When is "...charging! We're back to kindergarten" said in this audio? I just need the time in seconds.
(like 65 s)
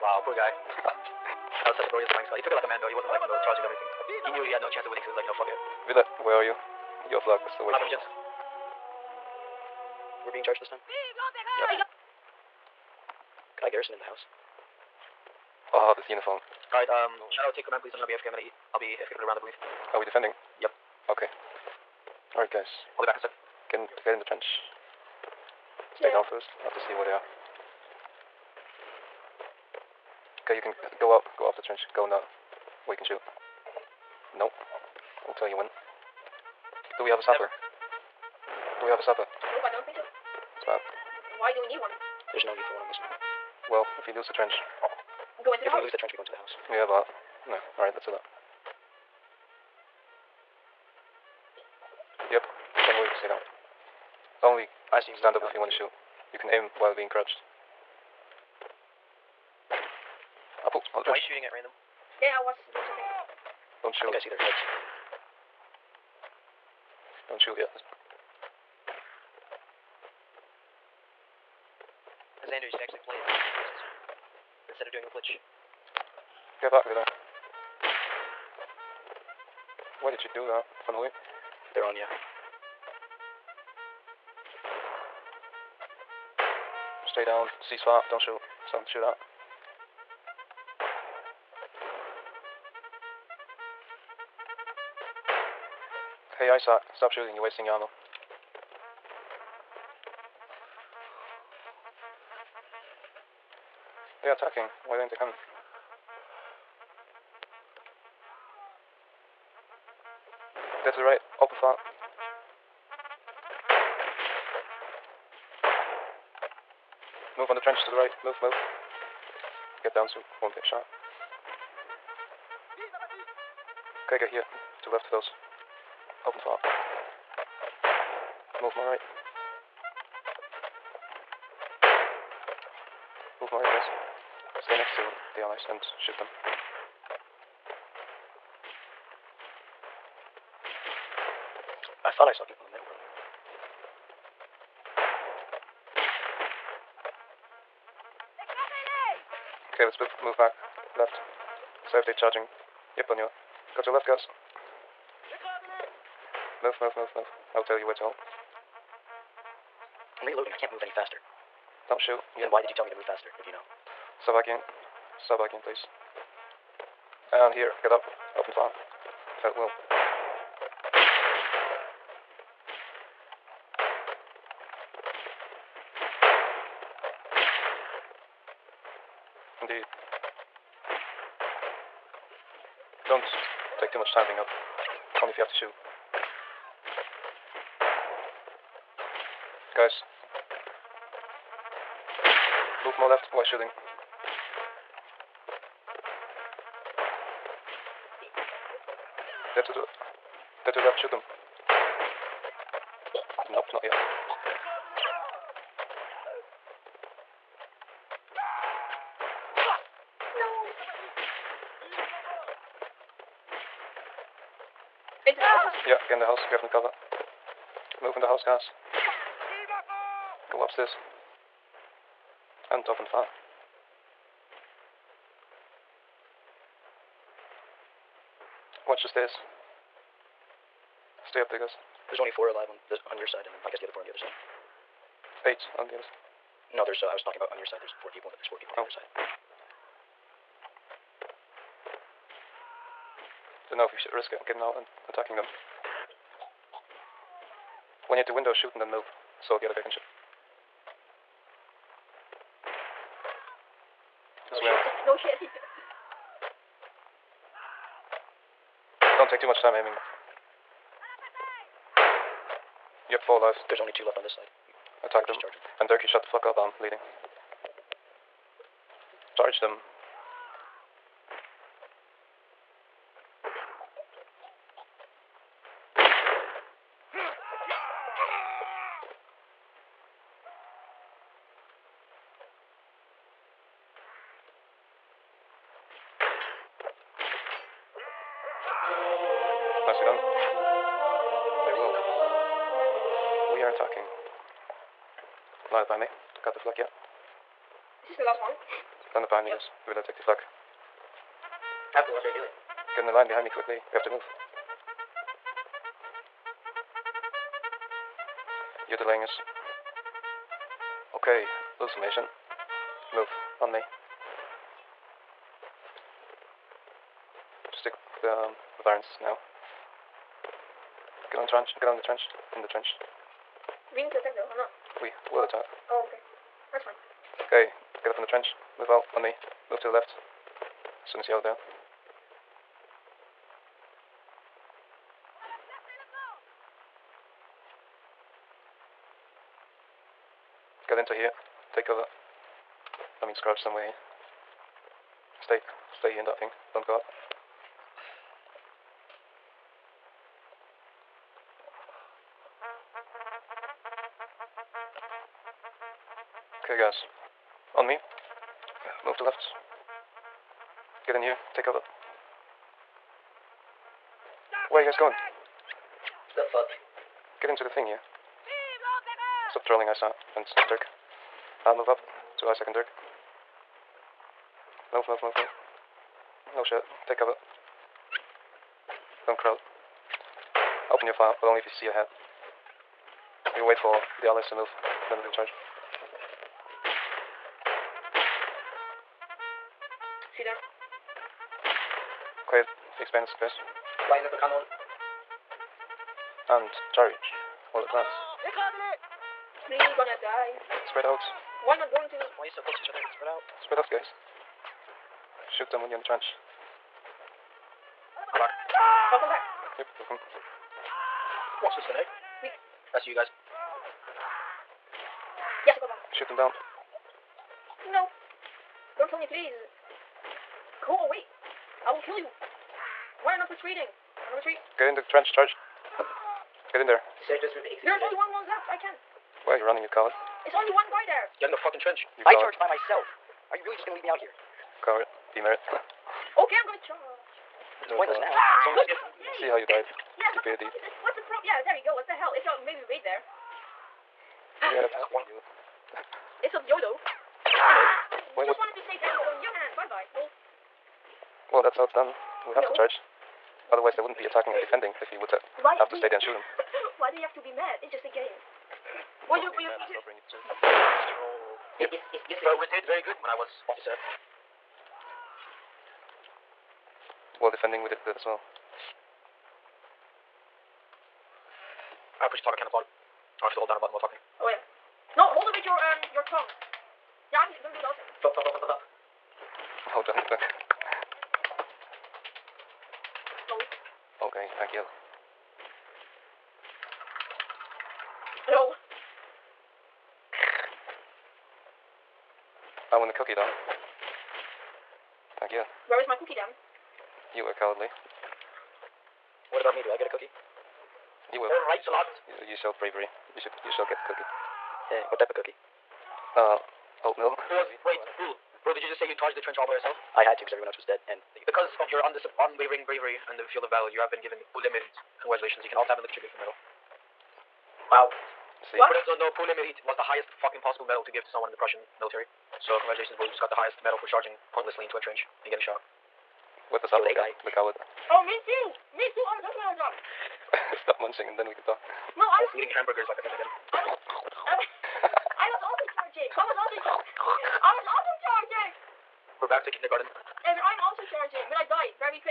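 538 s.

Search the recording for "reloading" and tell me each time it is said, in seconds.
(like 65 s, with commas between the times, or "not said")
160 s.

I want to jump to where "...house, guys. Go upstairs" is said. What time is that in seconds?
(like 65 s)
218 s.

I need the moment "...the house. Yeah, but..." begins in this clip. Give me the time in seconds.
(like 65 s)
46 s.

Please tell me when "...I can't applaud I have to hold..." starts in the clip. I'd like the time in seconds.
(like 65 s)
472 s.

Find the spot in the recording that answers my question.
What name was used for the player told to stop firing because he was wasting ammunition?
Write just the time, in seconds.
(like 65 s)
96 s.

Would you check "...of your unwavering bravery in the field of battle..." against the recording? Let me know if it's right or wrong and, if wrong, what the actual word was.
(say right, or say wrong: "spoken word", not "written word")
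right.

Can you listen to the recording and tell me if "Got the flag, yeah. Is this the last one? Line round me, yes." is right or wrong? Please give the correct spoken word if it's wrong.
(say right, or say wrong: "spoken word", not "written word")
wrong: "behind", not "round".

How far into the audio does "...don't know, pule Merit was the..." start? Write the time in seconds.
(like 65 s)
519 s.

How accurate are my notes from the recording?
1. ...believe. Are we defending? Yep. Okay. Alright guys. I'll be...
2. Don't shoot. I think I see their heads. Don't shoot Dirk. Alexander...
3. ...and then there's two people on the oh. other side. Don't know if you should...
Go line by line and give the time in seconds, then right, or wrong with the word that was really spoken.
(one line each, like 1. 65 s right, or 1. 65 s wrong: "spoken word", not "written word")
1. 19 s right
2. 63 s wrong: "Yeah", not "Dirk"
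3. 238 s wrong: "four", not "two".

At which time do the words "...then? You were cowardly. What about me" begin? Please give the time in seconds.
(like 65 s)
496 s.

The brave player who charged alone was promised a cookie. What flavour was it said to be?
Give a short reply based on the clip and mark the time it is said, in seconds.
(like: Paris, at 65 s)
oatmeal, at 507 s.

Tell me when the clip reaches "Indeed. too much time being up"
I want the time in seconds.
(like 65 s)
179 s.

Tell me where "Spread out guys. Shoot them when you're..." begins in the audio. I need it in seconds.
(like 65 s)
403 s.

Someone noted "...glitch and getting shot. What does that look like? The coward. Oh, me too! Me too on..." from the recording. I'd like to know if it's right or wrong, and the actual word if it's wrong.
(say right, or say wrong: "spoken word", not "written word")
wrong: "trench", not "glitch".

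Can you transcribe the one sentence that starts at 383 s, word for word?
You wait for the allies to move, then we'll charge.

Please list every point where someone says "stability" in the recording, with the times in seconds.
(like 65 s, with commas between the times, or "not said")
not said.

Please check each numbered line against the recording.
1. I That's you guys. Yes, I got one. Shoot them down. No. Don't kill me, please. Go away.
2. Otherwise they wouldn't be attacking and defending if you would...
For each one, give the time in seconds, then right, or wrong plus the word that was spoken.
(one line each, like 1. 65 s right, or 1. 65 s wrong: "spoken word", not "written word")
1. 412 s right
2. 453 s right.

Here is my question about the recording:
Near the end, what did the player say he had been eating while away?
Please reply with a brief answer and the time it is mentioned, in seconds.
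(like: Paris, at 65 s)
hamburgers, at 532 s.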